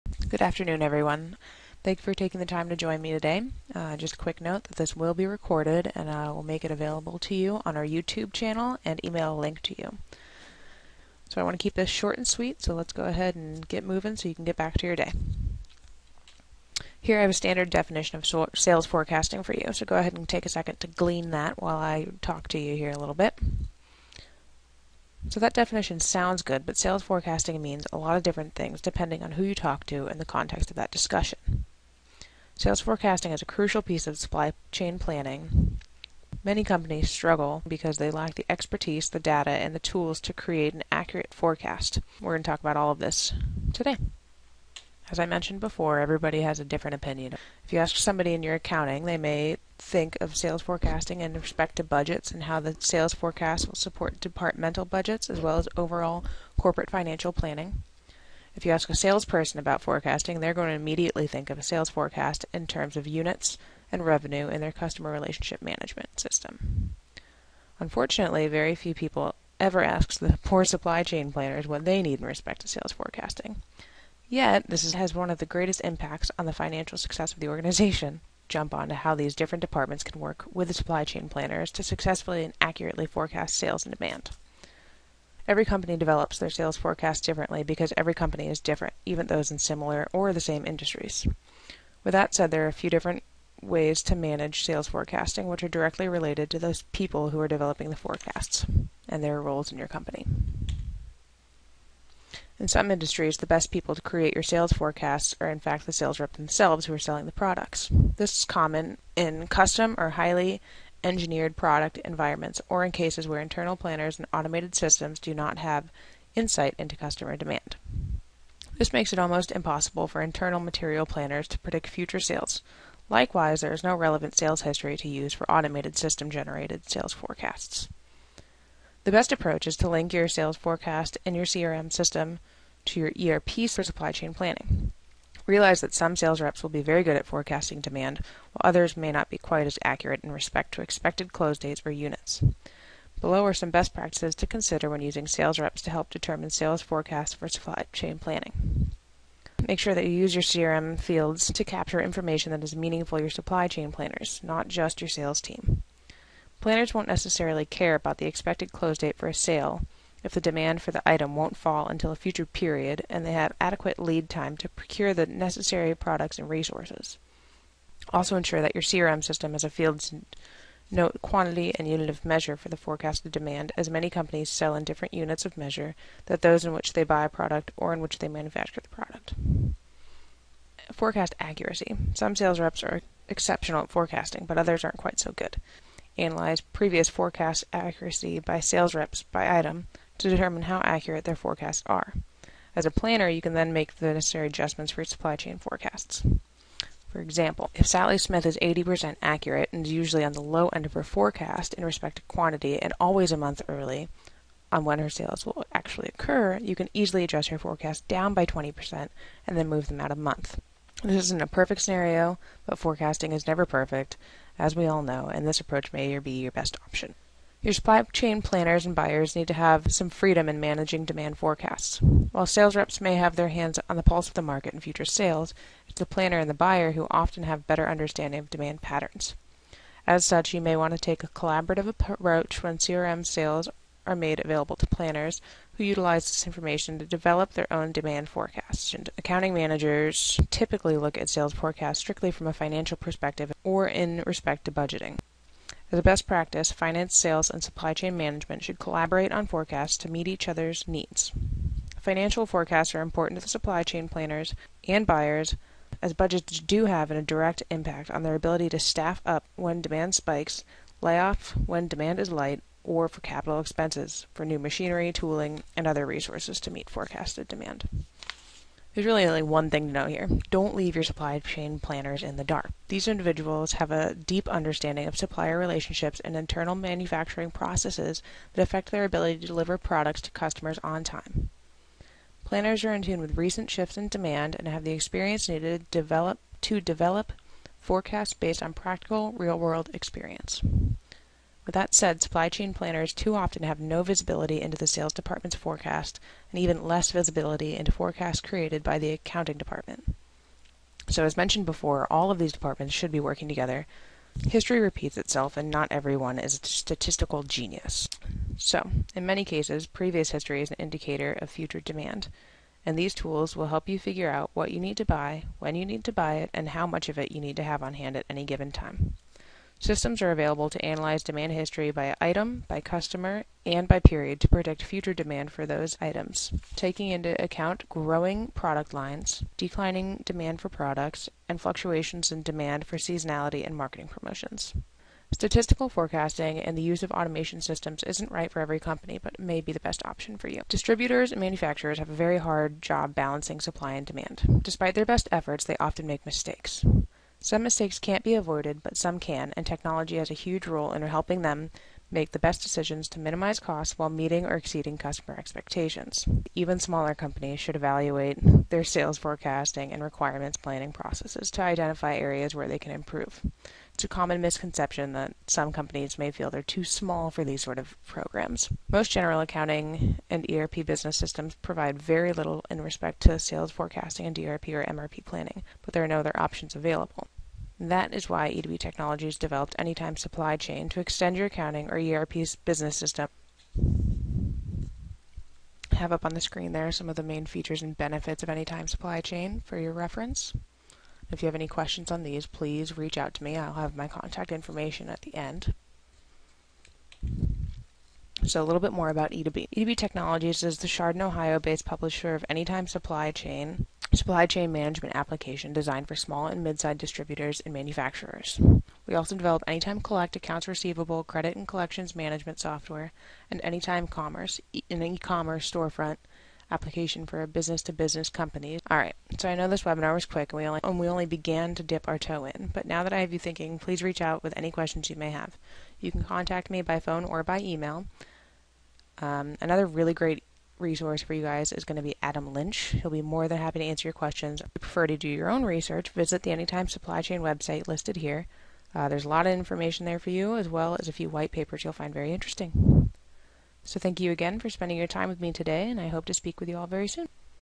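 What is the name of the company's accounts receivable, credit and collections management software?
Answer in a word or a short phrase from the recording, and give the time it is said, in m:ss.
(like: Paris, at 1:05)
Anytime Collect, at 6:49.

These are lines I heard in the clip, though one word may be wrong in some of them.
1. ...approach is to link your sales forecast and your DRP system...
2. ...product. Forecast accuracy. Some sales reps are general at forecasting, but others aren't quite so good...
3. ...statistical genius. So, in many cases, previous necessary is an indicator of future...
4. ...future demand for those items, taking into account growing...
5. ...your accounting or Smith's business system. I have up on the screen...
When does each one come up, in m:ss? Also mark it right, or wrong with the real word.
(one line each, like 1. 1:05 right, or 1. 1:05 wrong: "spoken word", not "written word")
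1. 2:09 wrong: "CRM", not "DRP"
2. 2:58 wrong: "exceptional", not "general"
3. 5:06 wrong: "history", not "necessary"
4. 5:24 right
5. 6:21 wrong: "ERP", not "Smith".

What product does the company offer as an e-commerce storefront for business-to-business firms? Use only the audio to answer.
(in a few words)
Anytime Commerce.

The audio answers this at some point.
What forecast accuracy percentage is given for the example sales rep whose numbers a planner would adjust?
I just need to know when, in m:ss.
3:18.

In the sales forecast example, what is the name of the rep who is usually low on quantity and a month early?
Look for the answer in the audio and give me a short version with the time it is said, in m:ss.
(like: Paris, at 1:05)
Sally Smith, at 3:17.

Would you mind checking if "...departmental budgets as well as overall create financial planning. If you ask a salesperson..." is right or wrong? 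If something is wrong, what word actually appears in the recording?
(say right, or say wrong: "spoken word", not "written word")
wrong: "corporate", not "create".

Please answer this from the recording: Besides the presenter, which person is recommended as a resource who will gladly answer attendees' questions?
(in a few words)
Adam Lynch.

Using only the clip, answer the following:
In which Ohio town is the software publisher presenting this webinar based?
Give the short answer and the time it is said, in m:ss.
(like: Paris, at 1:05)
Chardon, at 6:40.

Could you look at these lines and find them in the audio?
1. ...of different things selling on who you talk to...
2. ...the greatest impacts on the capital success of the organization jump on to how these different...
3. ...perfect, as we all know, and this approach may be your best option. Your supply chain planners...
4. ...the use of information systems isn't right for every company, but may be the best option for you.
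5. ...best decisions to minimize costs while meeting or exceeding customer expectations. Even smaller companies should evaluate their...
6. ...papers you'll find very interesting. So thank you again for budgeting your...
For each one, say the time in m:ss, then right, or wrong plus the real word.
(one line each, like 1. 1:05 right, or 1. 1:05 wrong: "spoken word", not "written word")
1. 0:28 wrong: "depending", not "selling"
2. 1:15 wrong: "financial", not "capital"
3. 3:33 right
4. 5:36 wrong: "automation", not "information"
5. 5:52 right
6. 7:21 wrong: "spending", not "budgeting".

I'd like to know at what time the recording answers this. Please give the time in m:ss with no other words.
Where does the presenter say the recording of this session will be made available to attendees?
0:07.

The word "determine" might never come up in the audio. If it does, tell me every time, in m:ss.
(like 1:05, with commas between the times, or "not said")
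2:26, 3:10.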